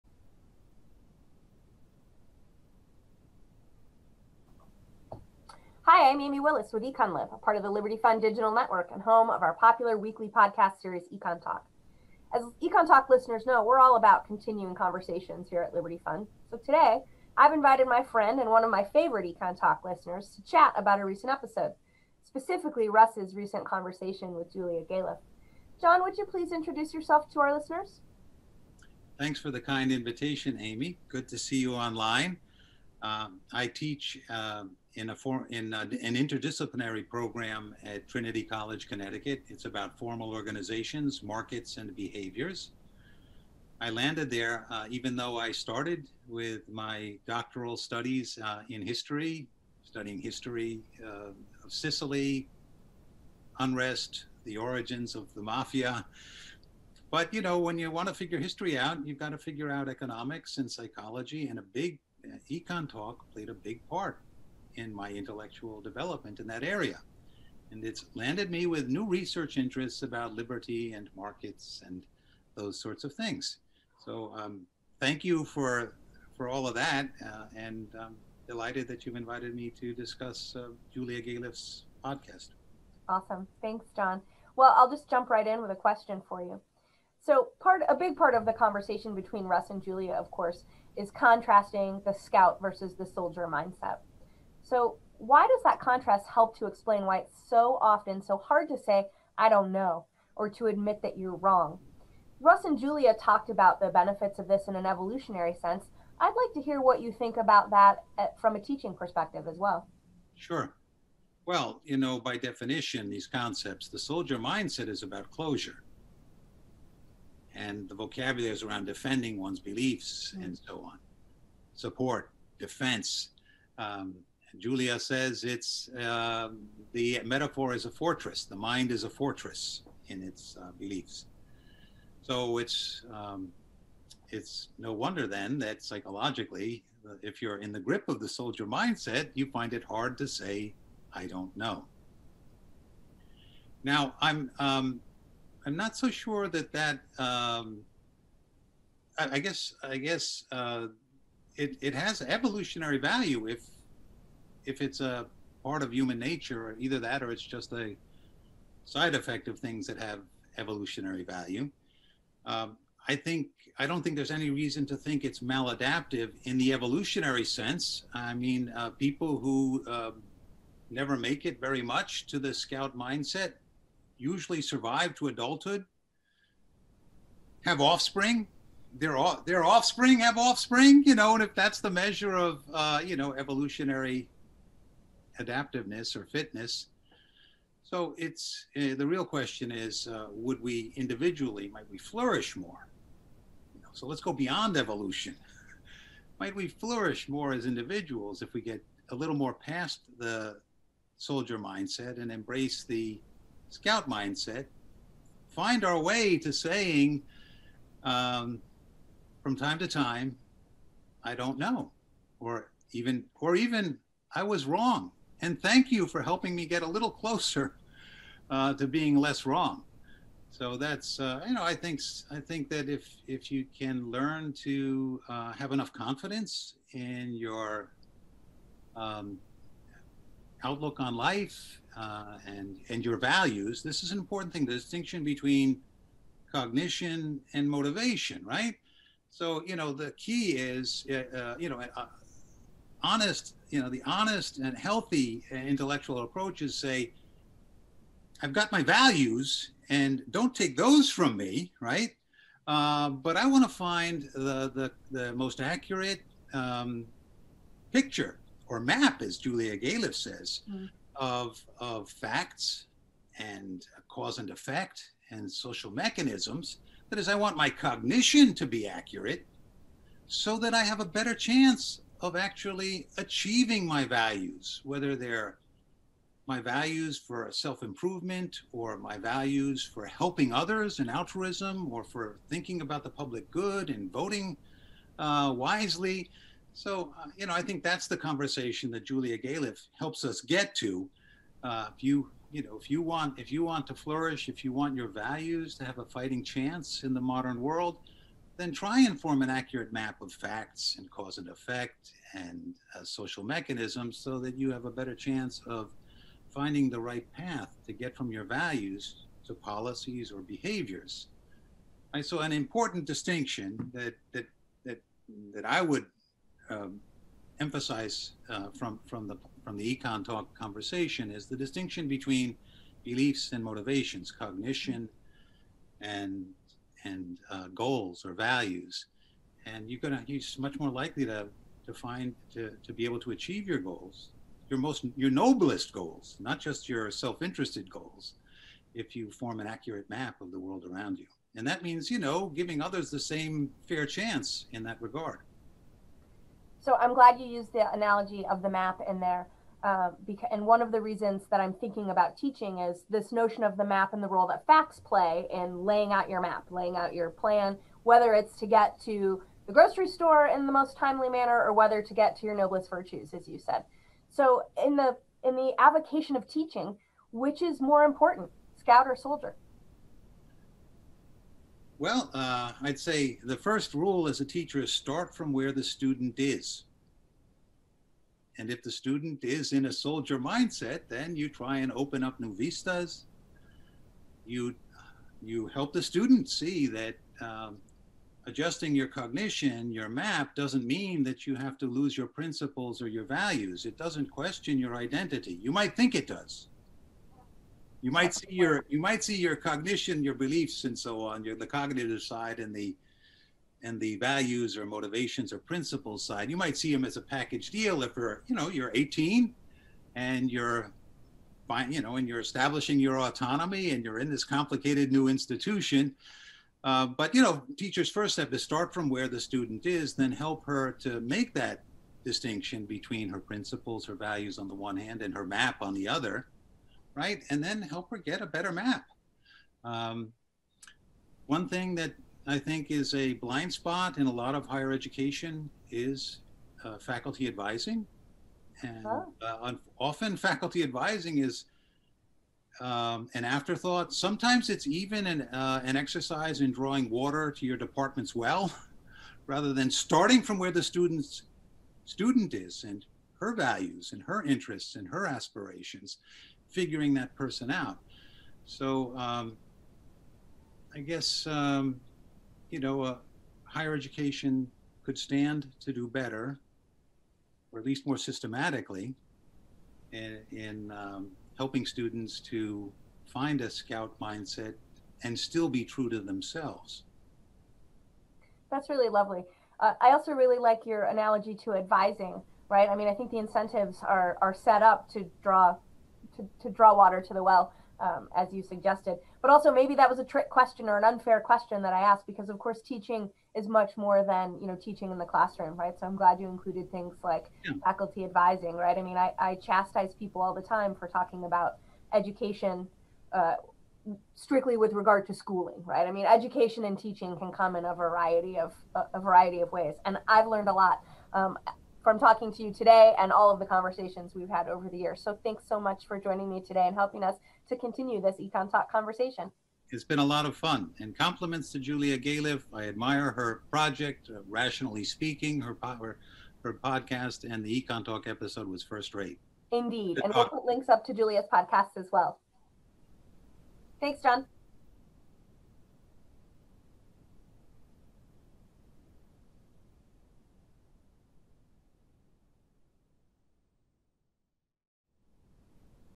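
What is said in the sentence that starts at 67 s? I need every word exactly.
And it's landed me with new research interests about liberty and markets and those sorts of things.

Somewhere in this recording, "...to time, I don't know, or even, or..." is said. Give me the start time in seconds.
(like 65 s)
209 s.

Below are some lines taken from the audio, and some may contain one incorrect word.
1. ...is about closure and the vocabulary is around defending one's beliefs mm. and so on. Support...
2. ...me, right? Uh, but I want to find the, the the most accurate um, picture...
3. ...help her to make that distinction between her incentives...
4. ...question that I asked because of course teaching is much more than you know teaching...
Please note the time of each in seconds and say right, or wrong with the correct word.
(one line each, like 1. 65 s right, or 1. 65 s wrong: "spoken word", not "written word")
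1. 114 s right
2. 251 s right
3. 420 s wrong: "principles", not "incentives"
4. 491 s right.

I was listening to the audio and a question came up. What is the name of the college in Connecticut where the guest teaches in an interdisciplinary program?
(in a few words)
Trinity College.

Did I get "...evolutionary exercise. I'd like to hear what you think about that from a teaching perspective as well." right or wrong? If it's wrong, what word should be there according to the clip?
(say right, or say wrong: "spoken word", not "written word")
wrong: "sense", not "exercise".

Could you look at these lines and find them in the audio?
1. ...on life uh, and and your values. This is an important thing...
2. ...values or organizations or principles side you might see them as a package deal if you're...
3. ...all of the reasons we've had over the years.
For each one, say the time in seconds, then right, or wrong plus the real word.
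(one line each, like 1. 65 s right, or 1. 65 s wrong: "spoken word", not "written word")
1. 230 s right
2. 404 s wrong: "motivations", not "organizations"
3. 513 s wrong: "conversations", not "reasons".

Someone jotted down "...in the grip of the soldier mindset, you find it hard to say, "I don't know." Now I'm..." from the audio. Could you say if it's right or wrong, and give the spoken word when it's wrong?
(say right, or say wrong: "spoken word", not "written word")
right.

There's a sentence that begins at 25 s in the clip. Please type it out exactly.
John, would you please introduce yourself to our listeners?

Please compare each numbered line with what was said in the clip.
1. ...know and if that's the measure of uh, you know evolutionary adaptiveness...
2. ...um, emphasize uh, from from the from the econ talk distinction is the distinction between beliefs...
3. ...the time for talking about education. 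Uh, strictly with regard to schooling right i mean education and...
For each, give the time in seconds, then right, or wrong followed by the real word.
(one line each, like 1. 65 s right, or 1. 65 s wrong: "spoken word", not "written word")
1. 181 s right
2. 316 s wrong: "conversation", not "distinction"
3. 500 s right.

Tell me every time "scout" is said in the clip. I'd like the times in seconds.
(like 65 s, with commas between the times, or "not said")
92 s, 172 s, 203 s, 368 s, 473 s.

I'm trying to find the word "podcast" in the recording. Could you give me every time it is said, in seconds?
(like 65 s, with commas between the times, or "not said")
10 s, 82 s, 526 s, 531 s.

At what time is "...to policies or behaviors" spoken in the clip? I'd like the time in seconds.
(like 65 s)
309 s.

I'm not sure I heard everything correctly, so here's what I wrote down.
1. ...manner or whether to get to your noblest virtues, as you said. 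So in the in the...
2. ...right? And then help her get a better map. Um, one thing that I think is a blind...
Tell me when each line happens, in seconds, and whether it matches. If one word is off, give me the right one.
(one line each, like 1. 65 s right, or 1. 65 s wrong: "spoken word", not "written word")
1. 361 s right
2. 427 s right.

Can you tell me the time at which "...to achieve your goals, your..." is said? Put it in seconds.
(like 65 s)
333 s.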